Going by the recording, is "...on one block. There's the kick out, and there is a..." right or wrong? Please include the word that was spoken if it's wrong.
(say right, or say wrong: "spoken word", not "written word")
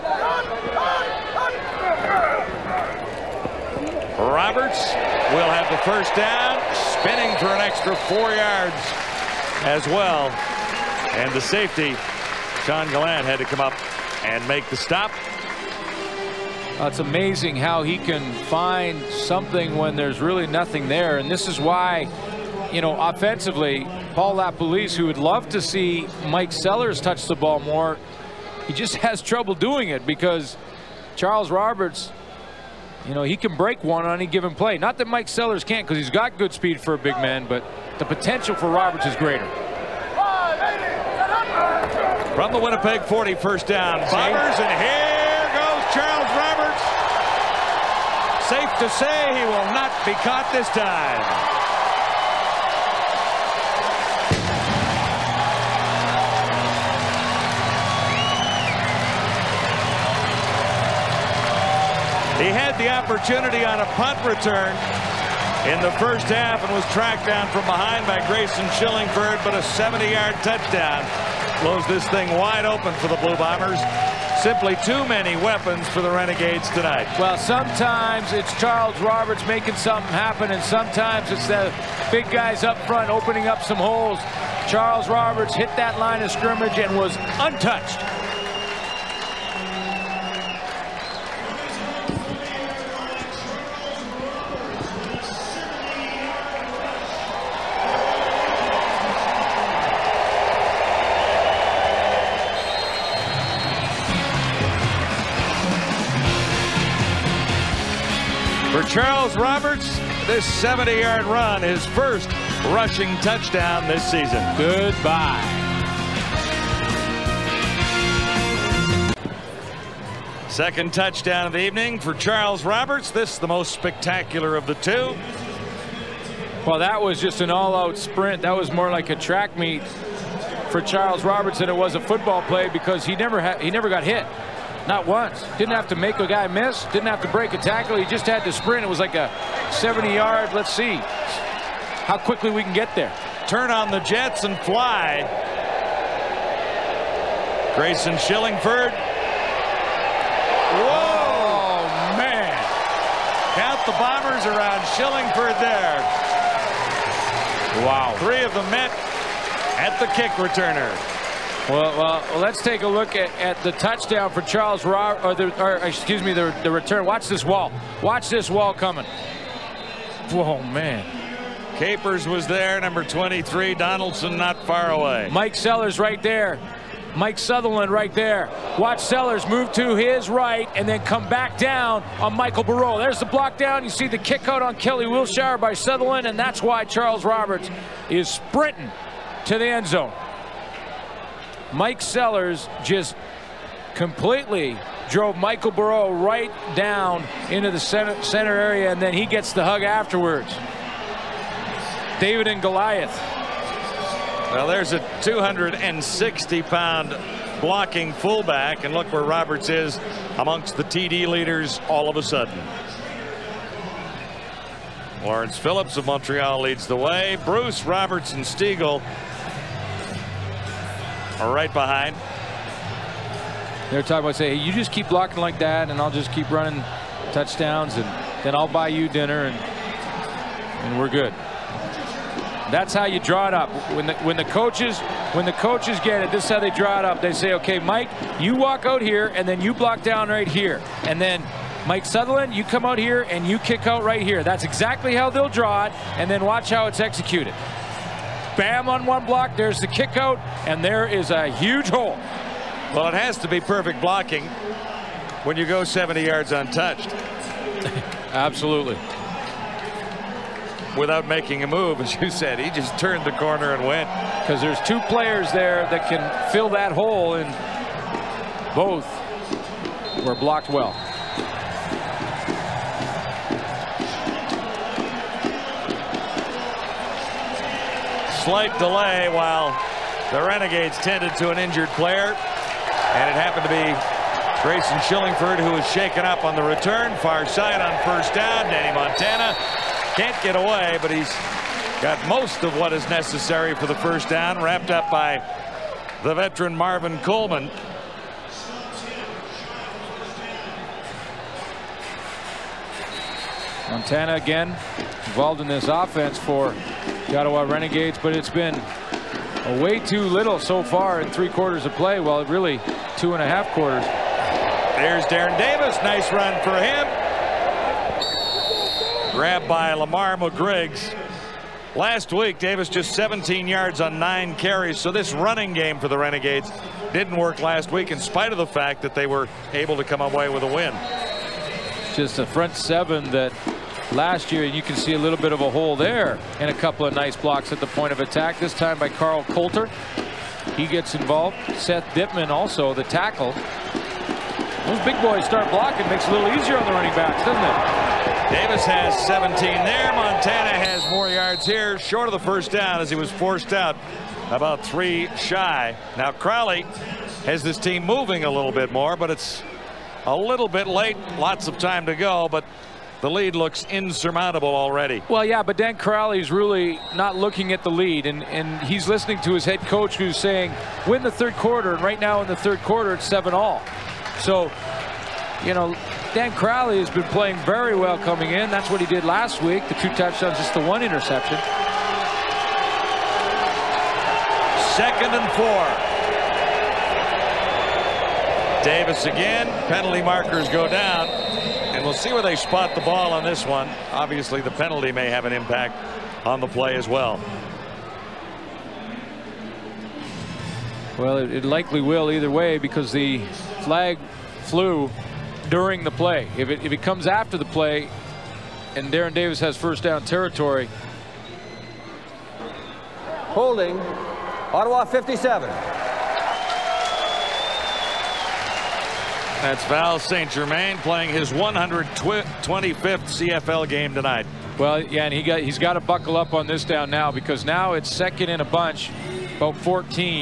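right.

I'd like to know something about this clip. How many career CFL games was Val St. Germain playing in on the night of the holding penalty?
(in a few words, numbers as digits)
125.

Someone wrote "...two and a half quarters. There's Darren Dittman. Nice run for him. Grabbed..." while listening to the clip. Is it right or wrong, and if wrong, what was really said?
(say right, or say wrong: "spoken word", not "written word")
wrong: "Davis", not "Dittman".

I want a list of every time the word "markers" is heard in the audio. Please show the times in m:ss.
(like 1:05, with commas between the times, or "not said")
6:30.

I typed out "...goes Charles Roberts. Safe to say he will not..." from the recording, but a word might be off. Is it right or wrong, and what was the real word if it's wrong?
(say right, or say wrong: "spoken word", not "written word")
right.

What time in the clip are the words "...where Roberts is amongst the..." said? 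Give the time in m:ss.
3:29.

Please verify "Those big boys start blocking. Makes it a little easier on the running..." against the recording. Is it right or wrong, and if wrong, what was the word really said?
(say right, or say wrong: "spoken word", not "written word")
right.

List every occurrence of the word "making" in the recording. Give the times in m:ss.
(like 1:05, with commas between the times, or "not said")
1:19, 4:21.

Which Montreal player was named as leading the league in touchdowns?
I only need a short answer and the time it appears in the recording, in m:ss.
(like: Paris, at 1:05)
Lawrence Phillips, at 3:35.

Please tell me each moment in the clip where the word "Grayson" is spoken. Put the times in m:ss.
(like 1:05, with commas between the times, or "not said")
1:08, 2:27, 4:44.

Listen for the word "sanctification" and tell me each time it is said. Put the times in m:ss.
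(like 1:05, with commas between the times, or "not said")
not said.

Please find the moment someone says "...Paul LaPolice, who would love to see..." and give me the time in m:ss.
0:24.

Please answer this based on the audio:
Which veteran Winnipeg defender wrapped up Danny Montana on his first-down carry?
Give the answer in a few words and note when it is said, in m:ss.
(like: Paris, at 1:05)
Marvin Coleman, at 4:56.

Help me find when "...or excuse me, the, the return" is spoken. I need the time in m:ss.
2:45.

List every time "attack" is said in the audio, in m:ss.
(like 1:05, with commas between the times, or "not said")
5:38.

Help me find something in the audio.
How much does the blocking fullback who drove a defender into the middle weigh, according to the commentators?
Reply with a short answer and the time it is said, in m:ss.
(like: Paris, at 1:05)
260 pounds, at 3:25.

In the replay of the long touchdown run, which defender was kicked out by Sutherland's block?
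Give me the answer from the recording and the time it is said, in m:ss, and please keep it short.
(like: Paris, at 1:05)
Kelly Wiltshire, at 3:04.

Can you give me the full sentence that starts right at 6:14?
So, you know, Dan Crowley has been playing very well coming in.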